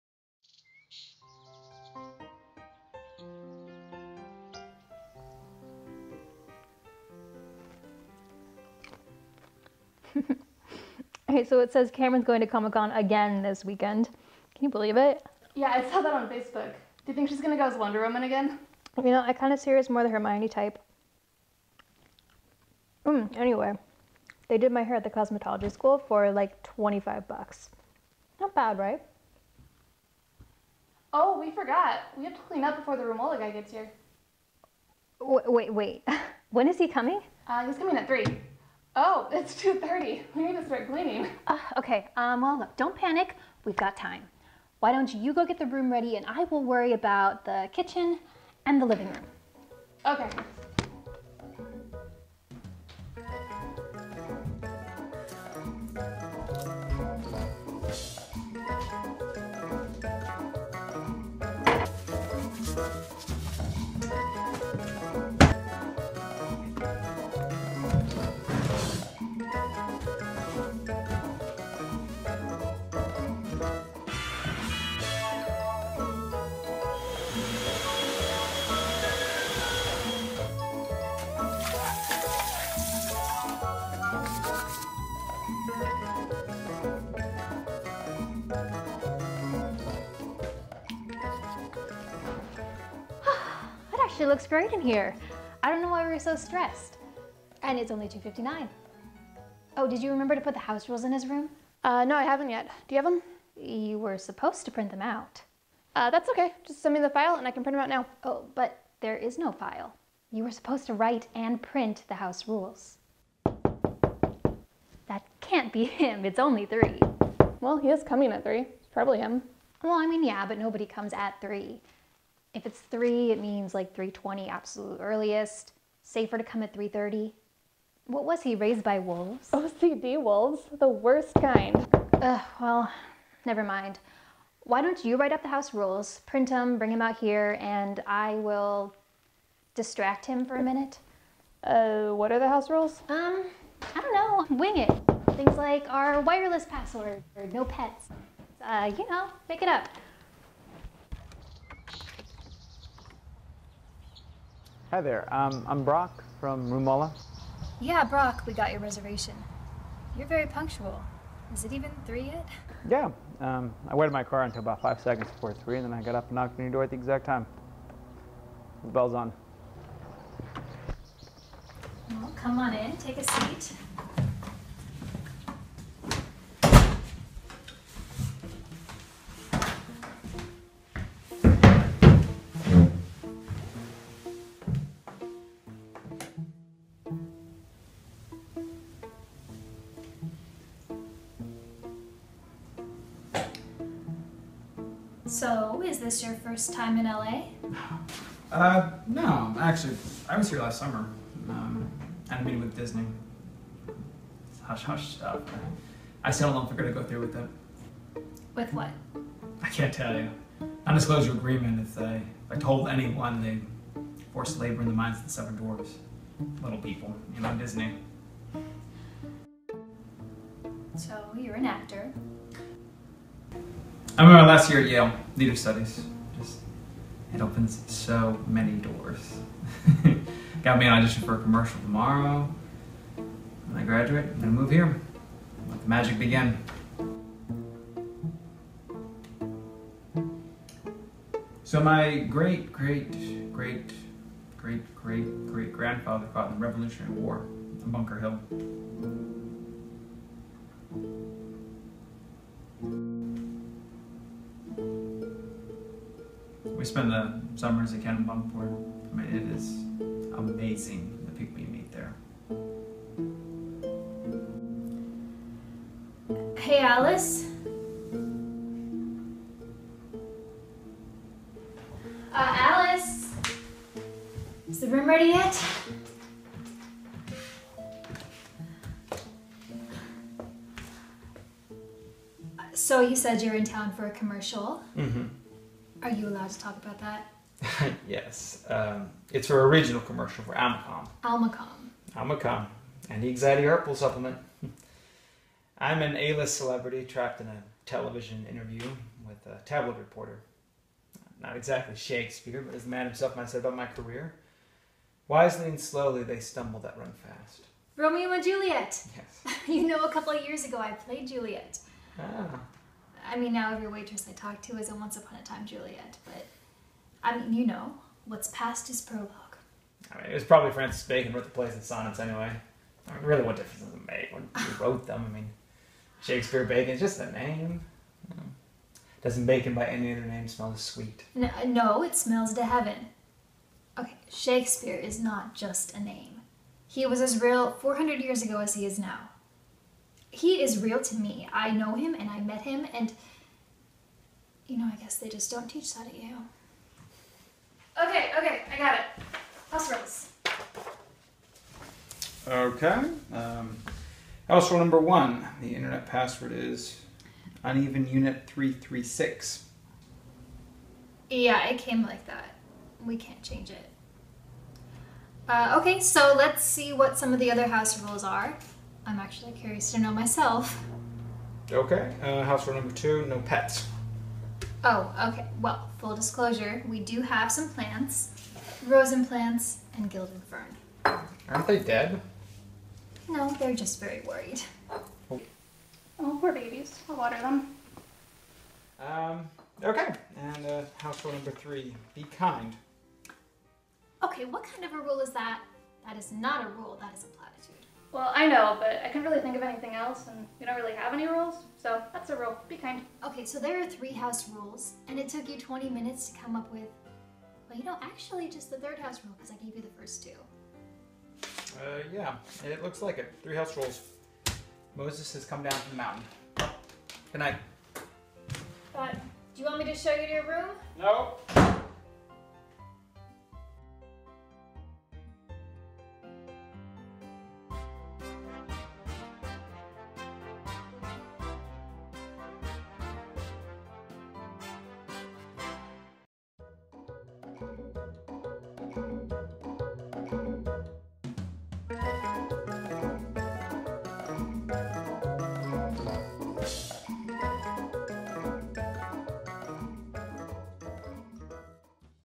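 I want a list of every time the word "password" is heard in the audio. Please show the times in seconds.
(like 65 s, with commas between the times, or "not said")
146 s, 356 s.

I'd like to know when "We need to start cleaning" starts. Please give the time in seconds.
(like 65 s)
40 s.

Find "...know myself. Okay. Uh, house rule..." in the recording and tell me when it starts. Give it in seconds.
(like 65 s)
369 s.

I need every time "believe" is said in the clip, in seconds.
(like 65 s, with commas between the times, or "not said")
14 s.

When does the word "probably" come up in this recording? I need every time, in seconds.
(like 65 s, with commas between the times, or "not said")
118 s, 320 s.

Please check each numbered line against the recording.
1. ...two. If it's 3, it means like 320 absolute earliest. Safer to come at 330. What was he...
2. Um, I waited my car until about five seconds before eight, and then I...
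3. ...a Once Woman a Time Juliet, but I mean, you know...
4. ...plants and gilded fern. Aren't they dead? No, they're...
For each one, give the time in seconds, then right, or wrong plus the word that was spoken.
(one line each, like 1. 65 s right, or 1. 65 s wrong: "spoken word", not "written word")
1. 121 s wrong: "three", not "two"
2. 163 s wrong: "three", not "eight"
3. 314 s wrong: "Upon", not "Woman"
4. 379 s right.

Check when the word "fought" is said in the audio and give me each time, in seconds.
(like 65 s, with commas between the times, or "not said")
246 s.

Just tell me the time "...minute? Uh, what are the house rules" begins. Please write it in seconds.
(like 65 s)
140 s.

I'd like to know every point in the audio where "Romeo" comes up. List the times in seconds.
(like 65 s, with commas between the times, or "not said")
307 s.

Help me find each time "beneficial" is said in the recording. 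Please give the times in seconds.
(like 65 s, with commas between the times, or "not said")
not said.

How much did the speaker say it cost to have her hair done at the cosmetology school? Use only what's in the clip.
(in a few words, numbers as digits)
$25.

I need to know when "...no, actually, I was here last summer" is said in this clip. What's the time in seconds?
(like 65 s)
199 s.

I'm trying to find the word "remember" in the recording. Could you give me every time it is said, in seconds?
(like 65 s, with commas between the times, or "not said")
100 s, 224 s.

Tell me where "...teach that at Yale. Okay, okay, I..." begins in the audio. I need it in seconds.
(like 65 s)
345 s.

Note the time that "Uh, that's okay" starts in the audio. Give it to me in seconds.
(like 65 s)
105 s.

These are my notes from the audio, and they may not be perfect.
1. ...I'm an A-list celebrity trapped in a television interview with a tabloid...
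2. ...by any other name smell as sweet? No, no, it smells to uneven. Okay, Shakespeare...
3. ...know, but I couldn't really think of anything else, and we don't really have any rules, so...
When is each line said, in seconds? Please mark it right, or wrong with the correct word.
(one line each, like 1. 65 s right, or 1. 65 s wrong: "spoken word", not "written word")
1. 295 s right
2. 329 s wrong: "heaven", not "uneven"
3. 398 s right.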